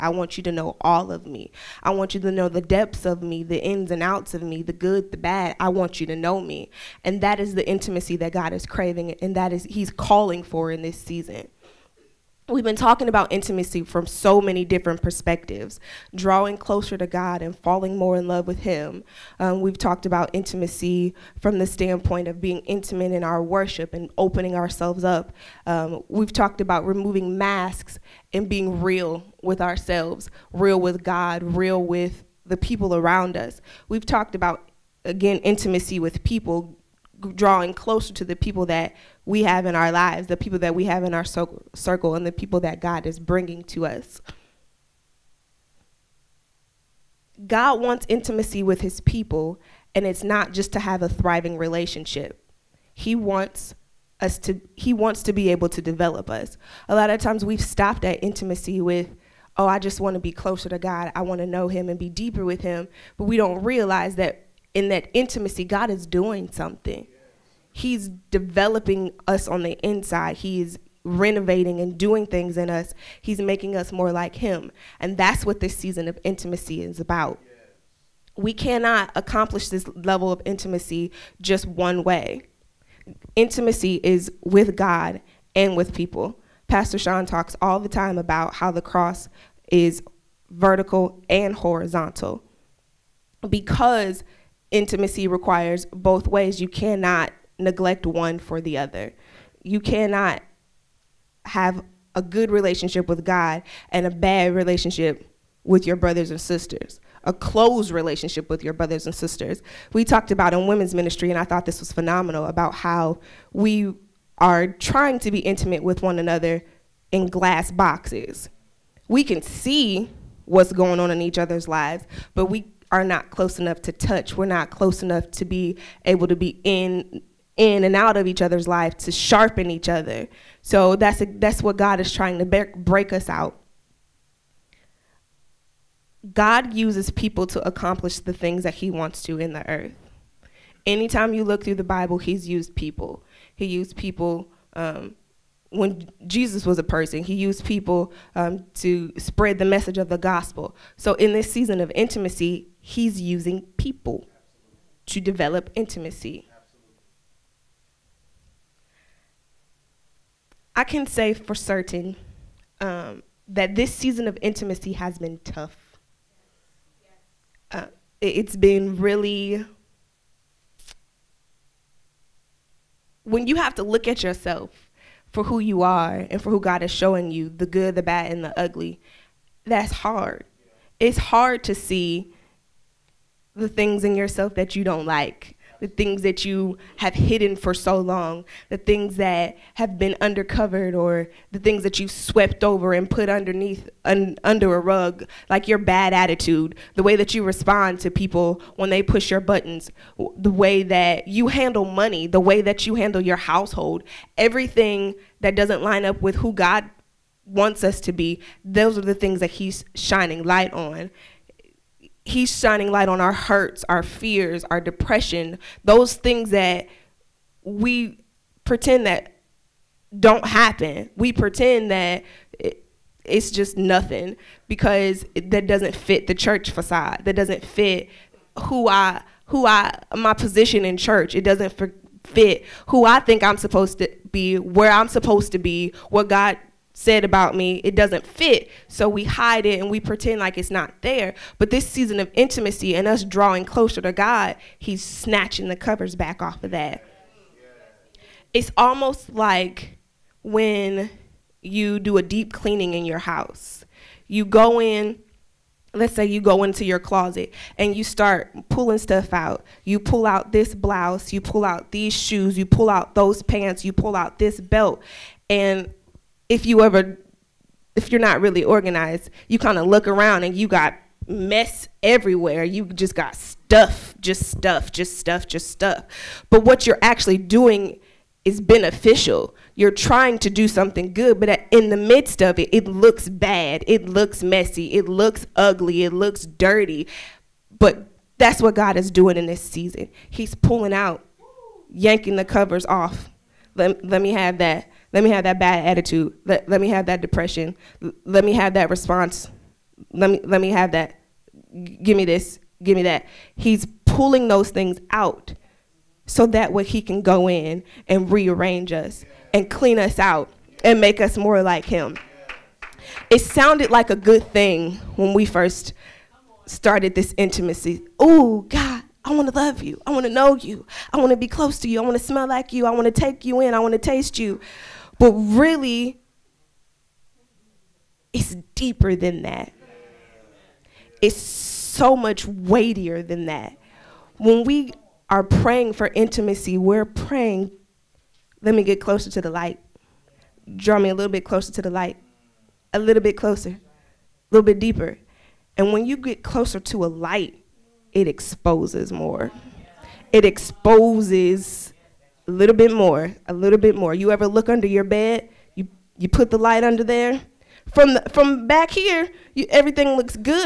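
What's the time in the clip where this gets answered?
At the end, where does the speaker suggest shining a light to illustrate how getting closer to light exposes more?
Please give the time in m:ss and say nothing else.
5:54.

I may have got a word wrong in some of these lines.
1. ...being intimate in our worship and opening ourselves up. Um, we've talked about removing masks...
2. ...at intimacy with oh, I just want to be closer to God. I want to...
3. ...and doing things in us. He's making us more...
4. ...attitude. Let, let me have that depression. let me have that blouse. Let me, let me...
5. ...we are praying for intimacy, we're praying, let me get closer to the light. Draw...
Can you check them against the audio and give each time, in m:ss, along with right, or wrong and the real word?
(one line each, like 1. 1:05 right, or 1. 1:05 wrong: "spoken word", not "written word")
1. 0:22 right
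2. 0:58 right
3. 1:11 right
4. 4:55 wrong: "response", not "blouse"
5. 5:34 right.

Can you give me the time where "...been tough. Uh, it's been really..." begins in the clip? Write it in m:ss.
2:45.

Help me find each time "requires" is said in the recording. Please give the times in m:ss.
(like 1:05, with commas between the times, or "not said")
1:35.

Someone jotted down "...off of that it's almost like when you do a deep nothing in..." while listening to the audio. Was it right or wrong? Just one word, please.
wrong.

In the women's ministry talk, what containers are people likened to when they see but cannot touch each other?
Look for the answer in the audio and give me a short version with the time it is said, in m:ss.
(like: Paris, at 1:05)
Glass boxes, at 1:57.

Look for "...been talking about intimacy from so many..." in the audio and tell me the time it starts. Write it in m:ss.
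0:12.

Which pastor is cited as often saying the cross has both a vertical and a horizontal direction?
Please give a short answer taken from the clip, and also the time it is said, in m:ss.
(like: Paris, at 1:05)
Pastor Sean, at 1:26.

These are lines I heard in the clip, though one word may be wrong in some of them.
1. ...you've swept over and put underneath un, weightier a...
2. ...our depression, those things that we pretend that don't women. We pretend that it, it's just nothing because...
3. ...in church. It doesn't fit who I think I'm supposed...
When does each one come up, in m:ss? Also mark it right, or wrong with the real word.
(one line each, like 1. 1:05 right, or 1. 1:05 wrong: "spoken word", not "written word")
1. 3:11 wrong: "under", not "weightier"
2. 3:34 wrong: "happen", not "women"
3. 3:50 right.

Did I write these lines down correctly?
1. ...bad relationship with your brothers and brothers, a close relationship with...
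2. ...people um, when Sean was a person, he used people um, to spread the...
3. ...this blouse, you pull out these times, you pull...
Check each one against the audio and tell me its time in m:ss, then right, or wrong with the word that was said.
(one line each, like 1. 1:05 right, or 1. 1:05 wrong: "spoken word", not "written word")
1. 1:44 wrong: "sisters", not "brothers"
2. 2:23 wrong: "Jesus", not "Sean"
3. 4:20 wrong: "shoes", not "times".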